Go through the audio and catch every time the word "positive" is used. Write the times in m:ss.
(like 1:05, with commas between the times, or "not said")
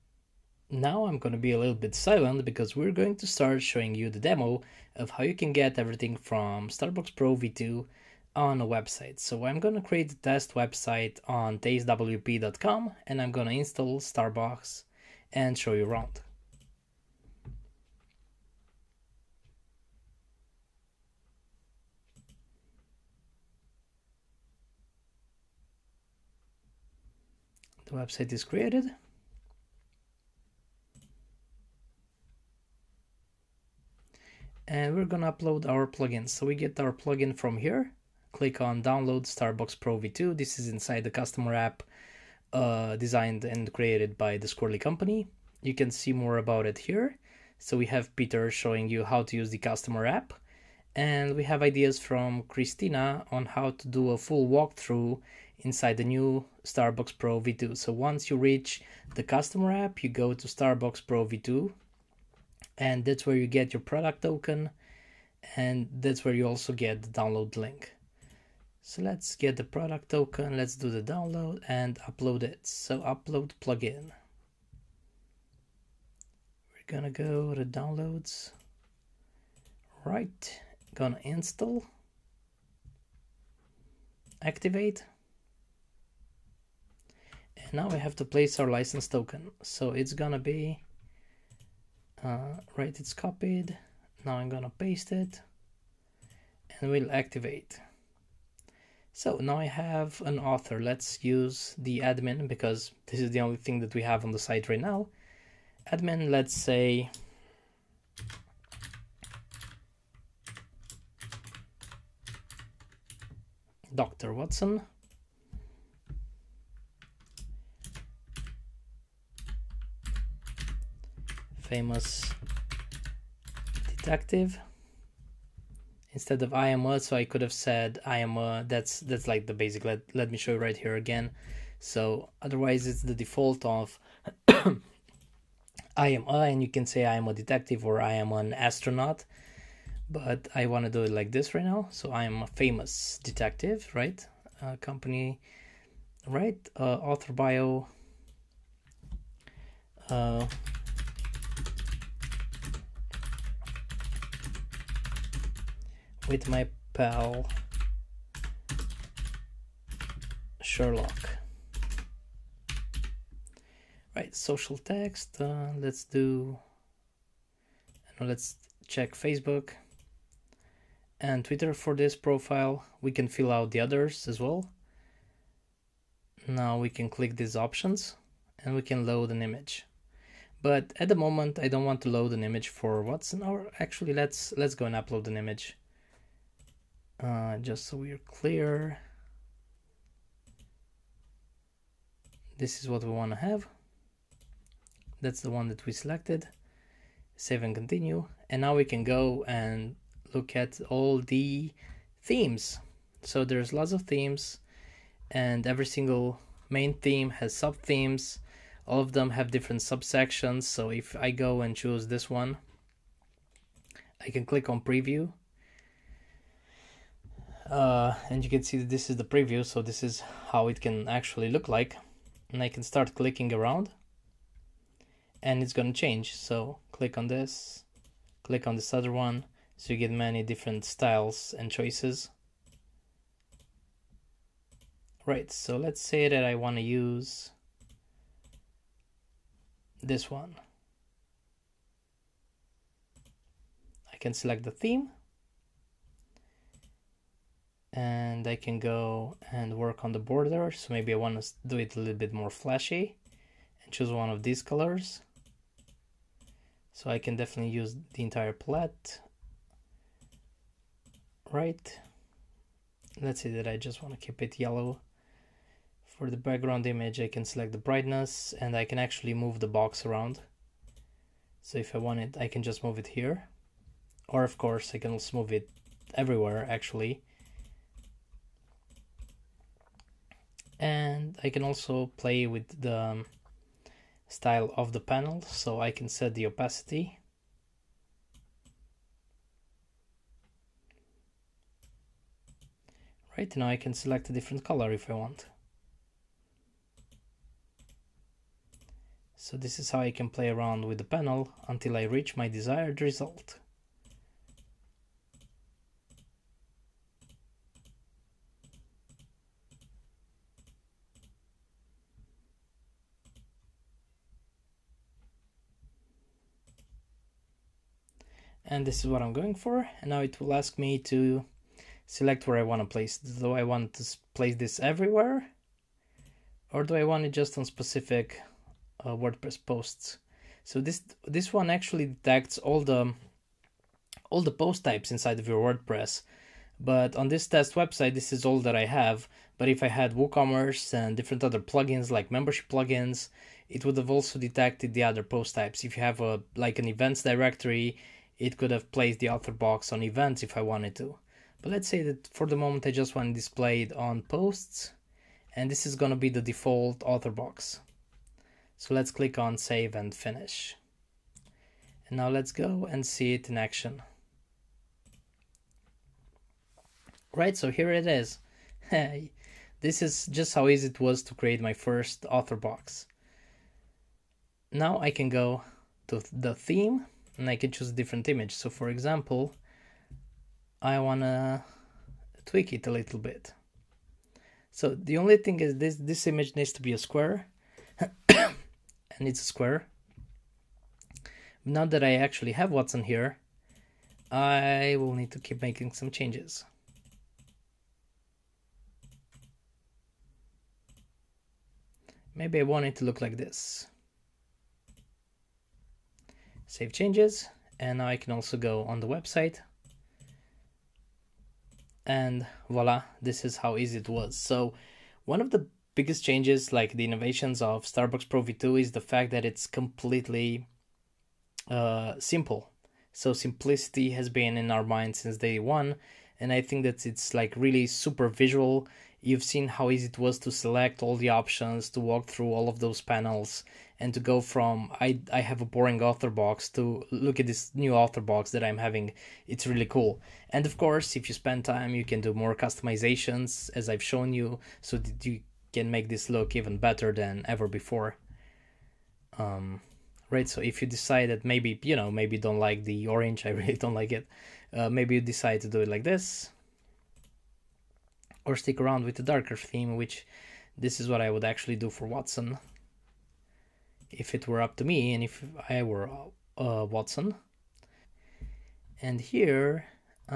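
not said.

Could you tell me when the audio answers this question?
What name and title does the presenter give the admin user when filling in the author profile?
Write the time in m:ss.
1:53.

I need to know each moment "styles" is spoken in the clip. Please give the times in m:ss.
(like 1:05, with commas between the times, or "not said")
3:50, 4:44.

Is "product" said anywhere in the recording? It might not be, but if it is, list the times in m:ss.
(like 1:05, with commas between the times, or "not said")
1:03, 1:09.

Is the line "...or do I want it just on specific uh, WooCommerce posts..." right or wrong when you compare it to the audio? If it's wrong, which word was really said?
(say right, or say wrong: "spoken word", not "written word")
wrong: "WordPress", not "WooCommerce".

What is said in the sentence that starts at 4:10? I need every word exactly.
So maybe I want to do it a little bit more flashy and choose one of these colors.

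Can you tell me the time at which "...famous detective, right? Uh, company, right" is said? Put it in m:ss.
2:22.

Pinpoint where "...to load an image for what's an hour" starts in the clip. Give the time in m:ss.
3:02.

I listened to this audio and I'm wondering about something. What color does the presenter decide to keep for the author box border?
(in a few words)
yellow.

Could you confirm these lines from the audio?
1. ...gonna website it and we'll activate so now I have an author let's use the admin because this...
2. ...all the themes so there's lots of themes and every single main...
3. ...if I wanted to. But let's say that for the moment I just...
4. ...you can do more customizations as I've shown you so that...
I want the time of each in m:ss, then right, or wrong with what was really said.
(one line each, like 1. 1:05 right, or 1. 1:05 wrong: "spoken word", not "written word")
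1. 1:34 wrong: "paste", not "website"
2. 3:20 right
3. 5:50 right
4. 7:21 right.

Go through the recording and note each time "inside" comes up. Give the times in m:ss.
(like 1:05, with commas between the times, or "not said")
0:40, 0:55, 5:35.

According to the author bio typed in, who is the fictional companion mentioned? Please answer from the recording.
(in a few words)
Sherlock.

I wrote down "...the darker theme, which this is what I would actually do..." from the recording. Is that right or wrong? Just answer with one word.
right.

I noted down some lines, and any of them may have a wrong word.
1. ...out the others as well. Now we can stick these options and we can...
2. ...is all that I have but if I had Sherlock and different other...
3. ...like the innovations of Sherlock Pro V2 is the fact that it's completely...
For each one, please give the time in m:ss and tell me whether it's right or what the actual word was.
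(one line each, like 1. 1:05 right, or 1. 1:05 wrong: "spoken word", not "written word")
1. 2:53 wrong: "click", not "stick"
2. 5:38 wrong: "WooCommerce", not "Sherlock"
3. 6:56 wrong: "Starbox", not "Sherlock".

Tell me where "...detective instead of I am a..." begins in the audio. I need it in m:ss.
2:03.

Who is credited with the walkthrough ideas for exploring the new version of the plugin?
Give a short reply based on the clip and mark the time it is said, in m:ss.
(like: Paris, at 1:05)
Christina, at 0:52.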